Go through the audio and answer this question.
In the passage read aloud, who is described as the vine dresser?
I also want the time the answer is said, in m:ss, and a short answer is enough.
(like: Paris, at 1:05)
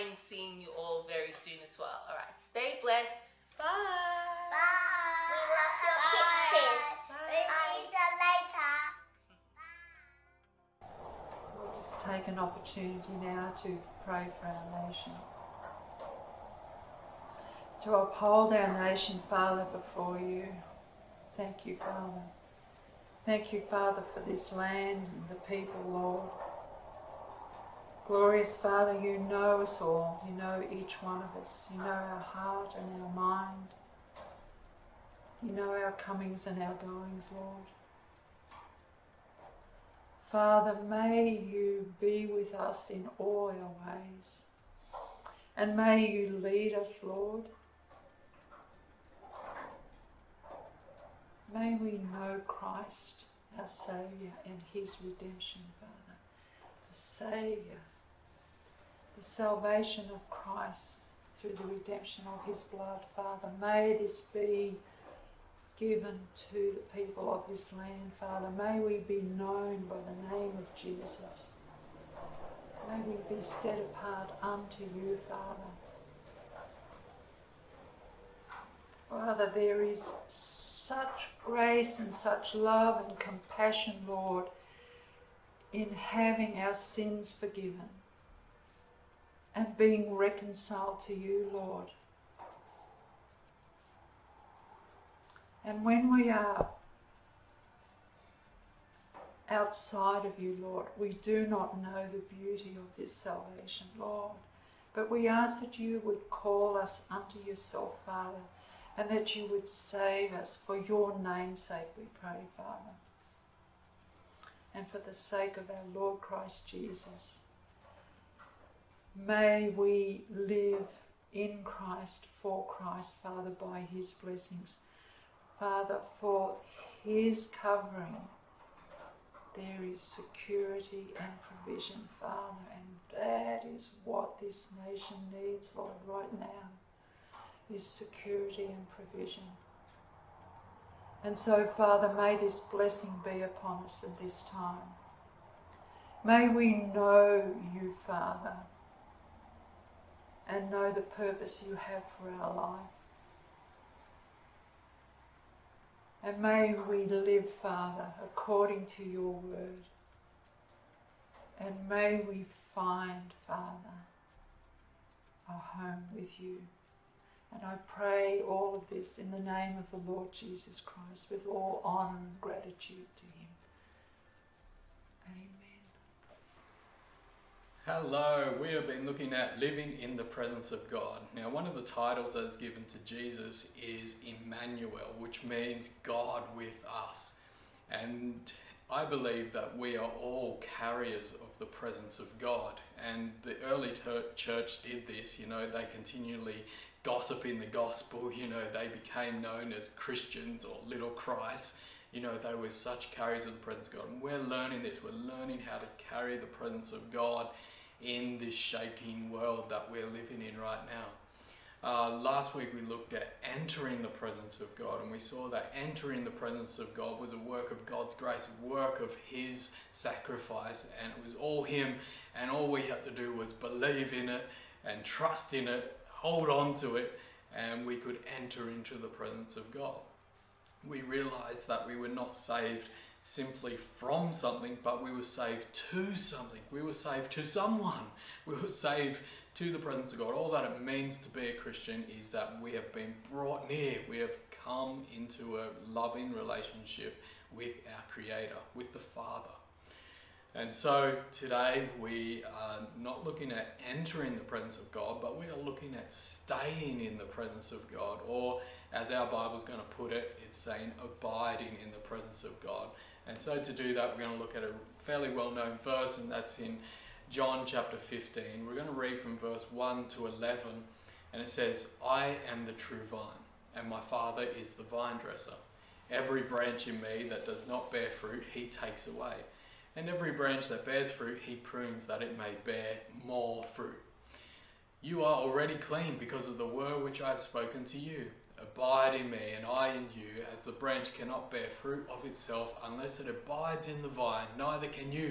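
My Father, at 4:33.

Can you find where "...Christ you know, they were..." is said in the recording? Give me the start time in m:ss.
3:21.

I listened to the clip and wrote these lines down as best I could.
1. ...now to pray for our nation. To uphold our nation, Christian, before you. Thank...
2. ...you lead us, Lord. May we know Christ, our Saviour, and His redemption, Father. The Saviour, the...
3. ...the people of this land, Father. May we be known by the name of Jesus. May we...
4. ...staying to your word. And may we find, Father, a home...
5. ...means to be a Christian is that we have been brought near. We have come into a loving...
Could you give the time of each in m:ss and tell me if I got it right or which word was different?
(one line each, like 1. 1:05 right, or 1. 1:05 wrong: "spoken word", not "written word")
1. 0:13 wrong: "Father", not "Christian"
2. 0:46 right
3. 1:06 right
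4. 2:38 wrong: "according", not "staying"
5. 4:00 right.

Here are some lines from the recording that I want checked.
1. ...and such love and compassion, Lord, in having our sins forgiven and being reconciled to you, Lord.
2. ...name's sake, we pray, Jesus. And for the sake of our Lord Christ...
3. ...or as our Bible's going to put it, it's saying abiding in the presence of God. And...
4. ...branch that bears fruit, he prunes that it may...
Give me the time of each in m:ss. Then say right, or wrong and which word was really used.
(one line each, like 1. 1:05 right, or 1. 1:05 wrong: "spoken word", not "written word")
1. 1:21 right
2. 1:51 wrong: "Father", not "Jesus"
3. 4:18 right
4. 4:40 right.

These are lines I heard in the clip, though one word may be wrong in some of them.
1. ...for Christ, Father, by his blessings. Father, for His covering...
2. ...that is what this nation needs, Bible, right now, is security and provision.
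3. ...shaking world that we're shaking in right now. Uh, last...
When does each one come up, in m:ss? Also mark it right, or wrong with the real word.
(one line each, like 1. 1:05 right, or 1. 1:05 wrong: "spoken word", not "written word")
1. 2:02 right
2. 2:13 wrong: "Lord", not "Bible"
3. 3:28 wrong: "living", not "shaking".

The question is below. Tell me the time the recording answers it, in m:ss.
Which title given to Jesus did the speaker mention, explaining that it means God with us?
3:04.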